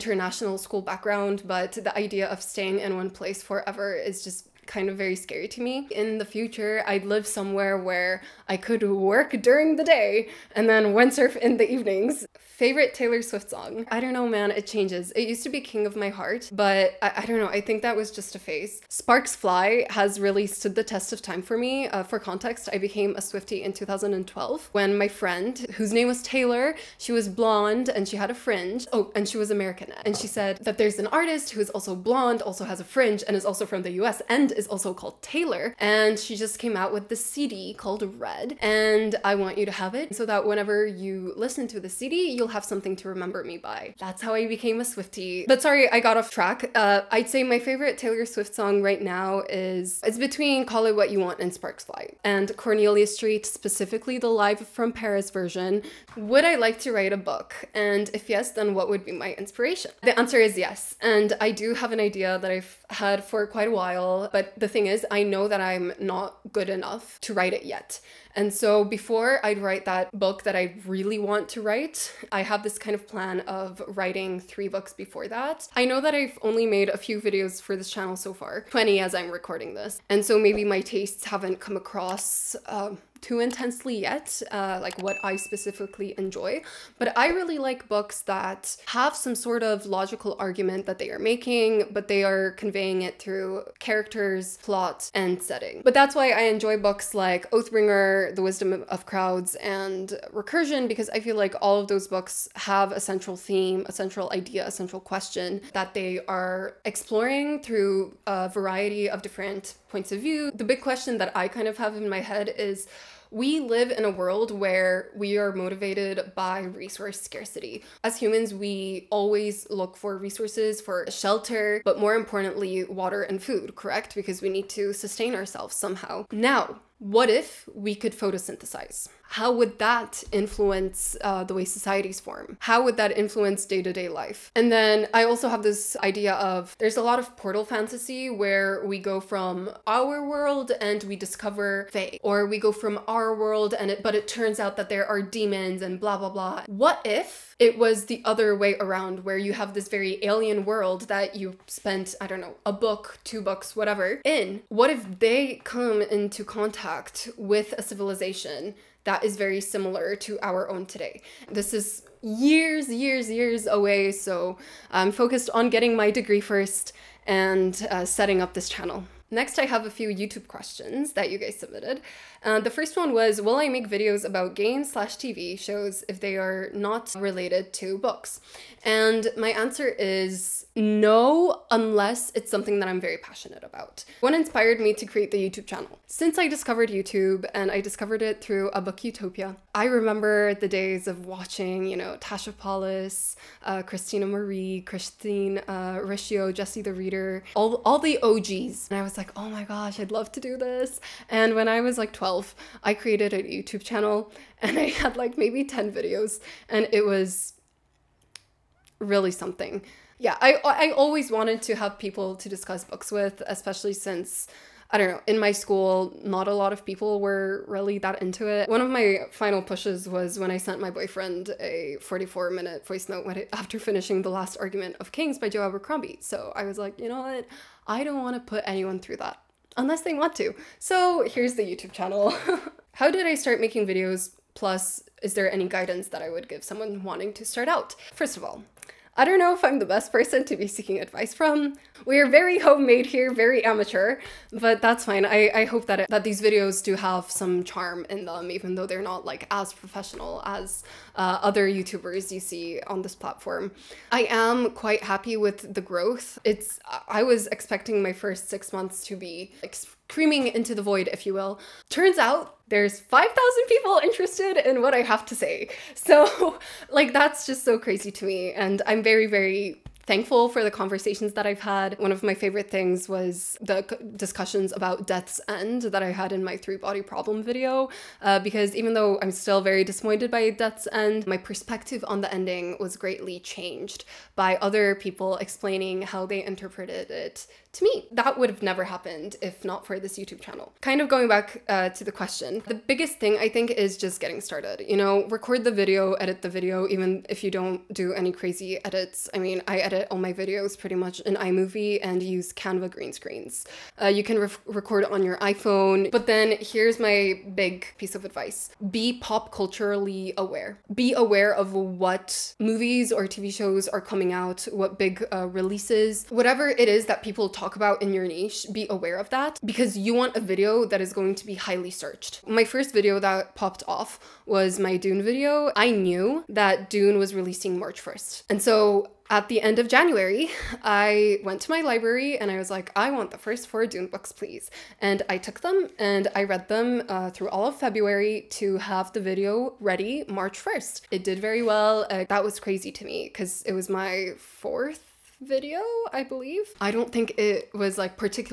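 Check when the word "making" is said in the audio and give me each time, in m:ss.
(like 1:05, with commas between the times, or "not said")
1:31, 3:53.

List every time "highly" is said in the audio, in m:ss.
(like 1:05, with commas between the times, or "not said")
5:21.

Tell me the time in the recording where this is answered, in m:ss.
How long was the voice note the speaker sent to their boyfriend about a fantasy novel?
3:41.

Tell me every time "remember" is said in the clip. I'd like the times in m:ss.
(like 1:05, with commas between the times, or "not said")
0:43, 3:09.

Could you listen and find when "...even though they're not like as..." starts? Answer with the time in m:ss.
4:08.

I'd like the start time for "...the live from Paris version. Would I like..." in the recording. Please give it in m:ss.
0:54.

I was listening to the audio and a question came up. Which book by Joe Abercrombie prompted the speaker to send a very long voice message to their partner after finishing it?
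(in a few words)
The Last Argument of Kings.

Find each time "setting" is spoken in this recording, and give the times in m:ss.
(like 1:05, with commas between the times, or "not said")
1:35, 2:48.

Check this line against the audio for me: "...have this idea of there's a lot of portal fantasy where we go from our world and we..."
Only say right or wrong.
right.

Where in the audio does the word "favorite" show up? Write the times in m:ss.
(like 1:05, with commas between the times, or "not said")
0:12, 0:47, 4:32.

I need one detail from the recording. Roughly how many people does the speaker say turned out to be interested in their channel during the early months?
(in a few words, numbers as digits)
5,000.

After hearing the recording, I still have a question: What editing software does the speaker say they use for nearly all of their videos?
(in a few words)
iMovie.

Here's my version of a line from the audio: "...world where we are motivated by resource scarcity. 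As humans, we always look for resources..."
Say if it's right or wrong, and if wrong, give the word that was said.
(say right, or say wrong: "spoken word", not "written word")
right.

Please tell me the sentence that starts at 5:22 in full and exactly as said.
My first video that popped off was my Dune video.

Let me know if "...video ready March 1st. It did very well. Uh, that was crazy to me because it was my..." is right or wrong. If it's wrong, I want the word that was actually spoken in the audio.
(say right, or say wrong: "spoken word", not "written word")
right.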